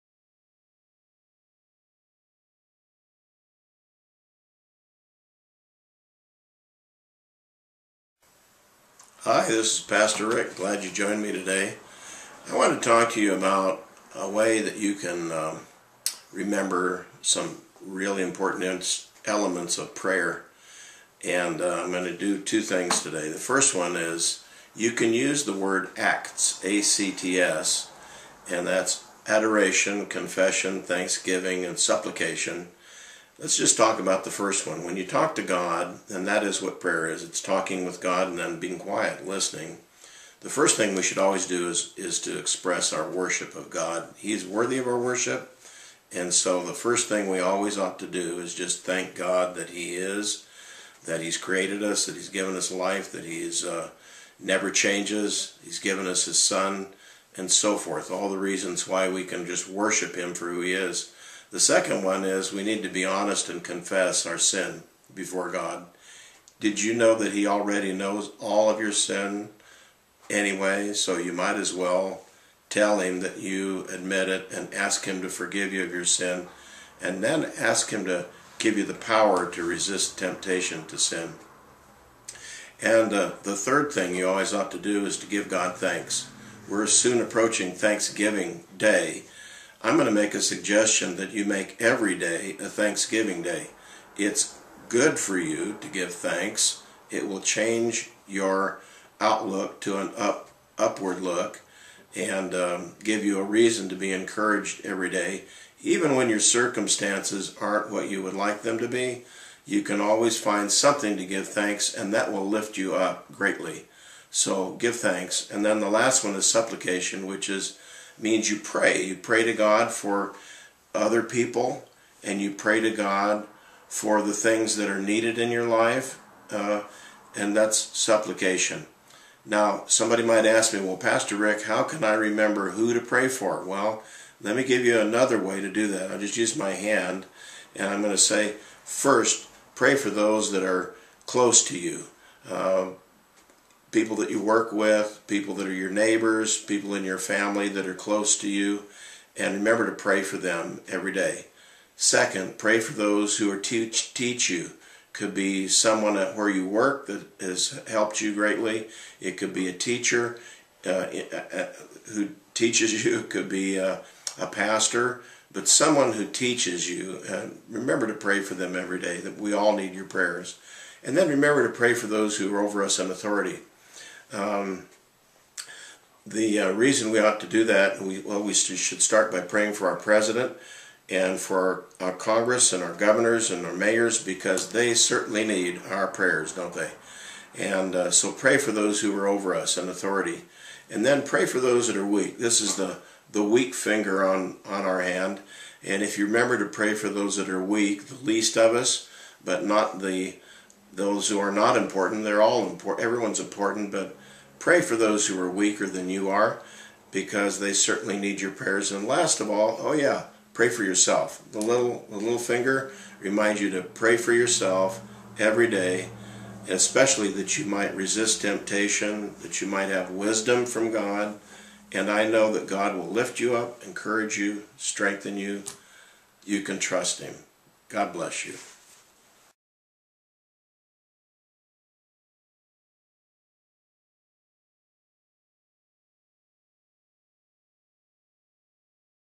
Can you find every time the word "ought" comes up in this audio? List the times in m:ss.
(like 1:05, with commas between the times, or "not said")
0:47, 1:24, 2:57.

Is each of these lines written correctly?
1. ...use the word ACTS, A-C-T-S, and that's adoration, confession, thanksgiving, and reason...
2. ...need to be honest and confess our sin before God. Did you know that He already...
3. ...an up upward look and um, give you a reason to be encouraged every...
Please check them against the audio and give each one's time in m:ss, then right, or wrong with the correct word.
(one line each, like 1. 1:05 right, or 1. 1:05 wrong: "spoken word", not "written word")
1. 0:25 wrong: "supplication", not "reason"
2. 1:02 right
3. 1:39 right.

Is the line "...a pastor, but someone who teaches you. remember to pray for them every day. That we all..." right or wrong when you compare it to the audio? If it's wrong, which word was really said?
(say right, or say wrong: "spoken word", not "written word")
right.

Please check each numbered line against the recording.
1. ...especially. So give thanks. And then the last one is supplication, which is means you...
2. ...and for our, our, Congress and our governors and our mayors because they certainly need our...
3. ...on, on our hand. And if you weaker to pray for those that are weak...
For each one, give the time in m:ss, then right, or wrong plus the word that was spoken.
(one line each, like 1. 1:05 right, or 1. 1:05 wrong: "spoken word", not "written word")
1. 1:53 wrong: "greatly", not "especially"
2. 3:01 right
3. 3:14 wrong: "remember", not "weaker".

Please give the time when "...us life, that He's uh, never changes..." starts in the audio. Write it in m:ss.
0:52.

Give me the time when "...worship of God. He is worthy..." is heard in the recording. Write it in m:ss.
0:43.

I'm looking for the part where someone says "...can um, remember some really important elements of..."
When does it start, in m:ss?
0:14.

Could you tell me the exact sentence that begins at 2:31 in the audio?
Second, pray for those who are teach, teach you.